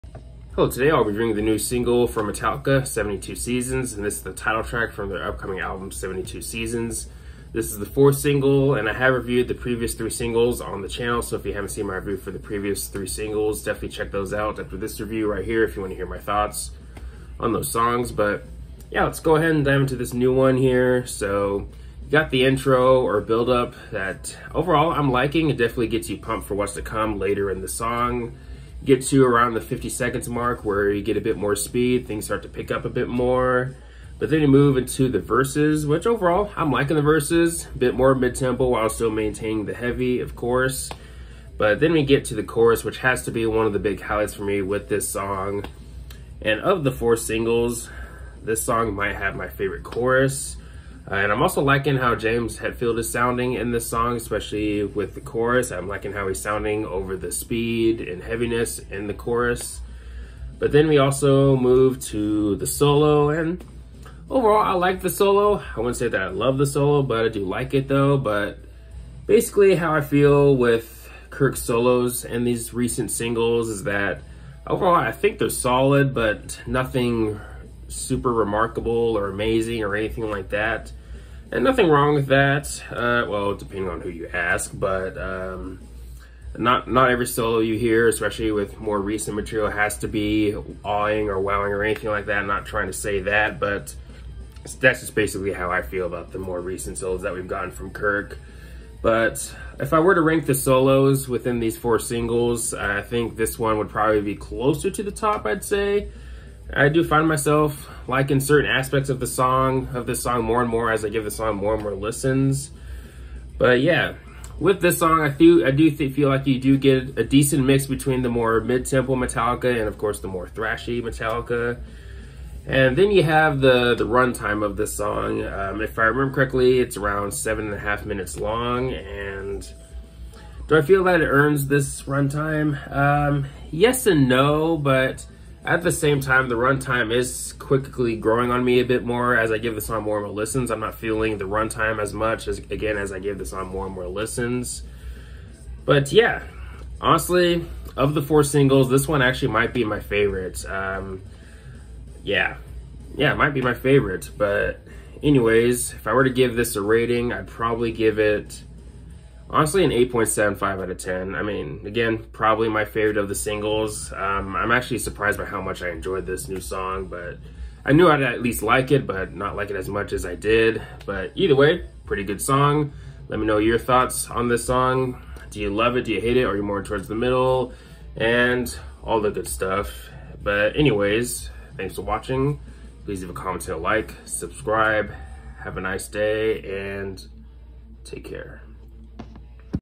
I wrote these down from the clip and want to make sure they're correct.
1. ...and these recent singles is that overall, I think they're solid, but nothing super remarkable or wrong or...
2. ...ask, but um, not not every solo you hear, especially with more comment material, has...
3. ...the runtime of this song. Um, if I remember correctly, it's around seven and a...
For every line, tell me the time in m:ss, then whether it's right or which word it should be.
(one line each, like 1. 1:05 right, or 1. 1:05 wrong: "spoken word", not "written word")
1. 1:12 wrong: "amazing", not "wrong"
2. 1:24 wrong: "recent", not "comment"
3. 2:03 right.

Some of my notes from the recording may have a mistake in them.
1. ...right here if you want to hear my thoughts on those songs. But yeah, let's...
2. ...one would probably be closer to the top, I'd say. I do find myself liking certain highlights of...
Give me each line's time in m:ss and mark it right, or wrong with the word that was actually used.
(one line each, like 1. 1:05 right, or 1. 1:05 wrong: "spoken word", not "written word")
1. 0:15 right
2. 1:43 wrong: "aspects", not "highlights".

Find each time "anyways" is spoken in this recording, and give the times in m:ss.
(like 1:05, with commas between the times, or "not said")
2:35, 3:00.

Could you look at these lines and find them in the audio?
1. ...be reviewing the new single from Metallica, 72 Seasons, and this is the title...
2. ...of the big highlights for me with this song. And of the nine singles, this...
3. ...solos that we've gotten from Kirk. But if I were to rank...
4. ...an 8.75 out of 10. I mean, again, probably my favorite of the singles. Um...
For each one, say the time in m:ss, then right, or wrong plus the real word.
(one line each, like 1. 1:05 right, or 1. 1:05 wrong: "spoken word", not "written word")
1. 0:01 right
2. 0:43 wrong: "four", not "nine"
3. 1:36 right
4. 2:39 right.